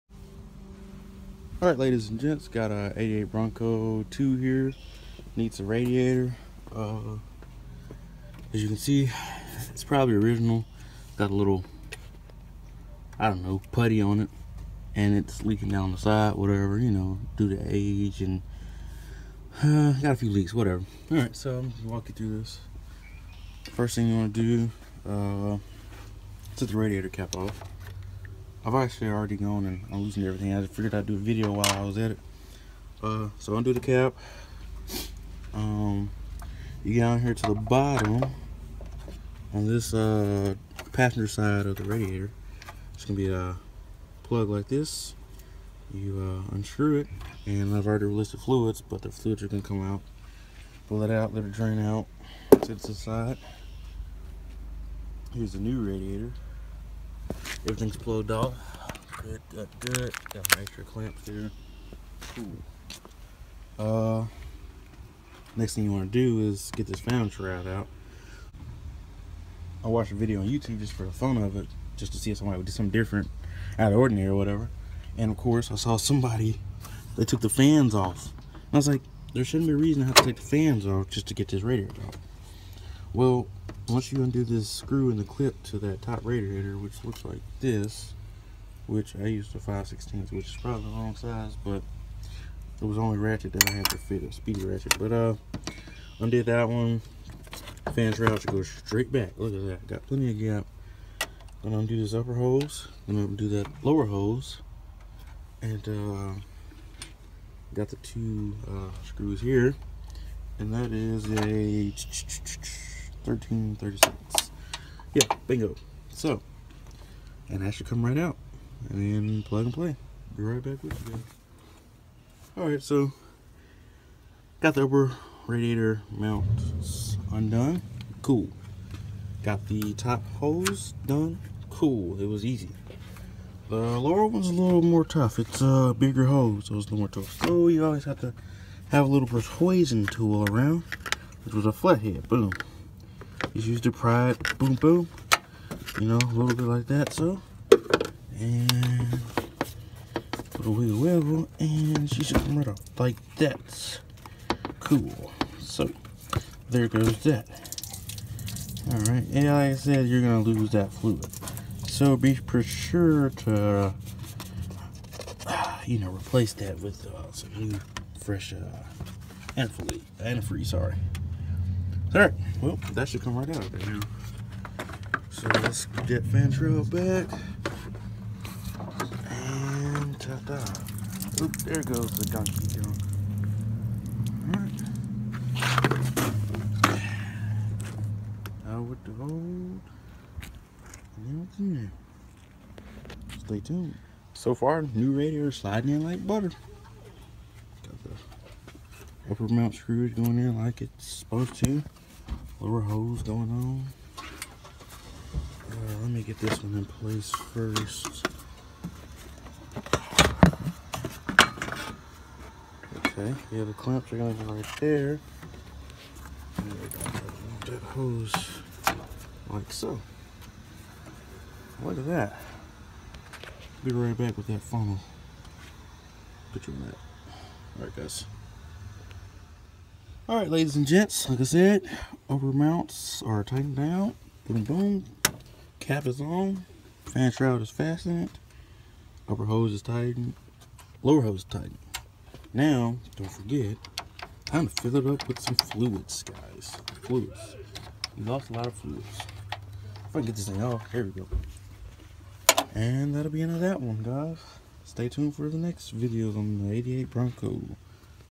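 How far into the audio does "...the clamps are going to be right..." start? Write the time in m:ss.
3:33.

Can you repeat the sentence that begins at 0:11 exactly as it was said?
Got a little, I don't know, putty on it.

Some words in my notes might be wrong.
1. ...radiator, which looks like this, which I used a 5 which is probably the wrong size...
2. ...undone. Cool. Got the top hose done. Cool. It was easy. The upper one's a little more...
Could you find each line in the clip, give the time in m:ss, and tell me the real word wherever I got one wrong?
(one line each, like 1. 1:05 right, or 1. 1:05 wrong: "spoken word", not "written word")
1. 1:26 right
2. 2:07 wrong: "lower", not "upper".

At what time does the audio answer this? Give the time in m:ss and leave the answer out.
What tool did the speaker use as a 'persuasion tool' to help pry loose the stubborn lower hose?
2:21.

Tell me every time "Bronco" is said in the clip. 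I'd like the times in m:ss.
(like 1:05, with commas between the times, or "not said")
0:03, 4:17.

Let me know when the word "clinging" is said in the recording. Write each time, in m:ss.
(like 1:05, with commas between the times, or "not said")
not said.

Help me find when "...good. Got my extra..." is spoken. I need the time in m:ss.
0:59.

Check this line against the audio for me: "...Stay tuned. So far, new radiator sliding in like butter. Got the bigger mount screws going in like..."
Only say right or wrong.
wrong.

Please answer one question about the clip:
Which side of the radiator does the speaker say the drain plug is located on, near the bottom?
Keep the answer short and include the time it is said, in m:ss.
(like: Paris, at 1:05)
Passenger side, at 0:40.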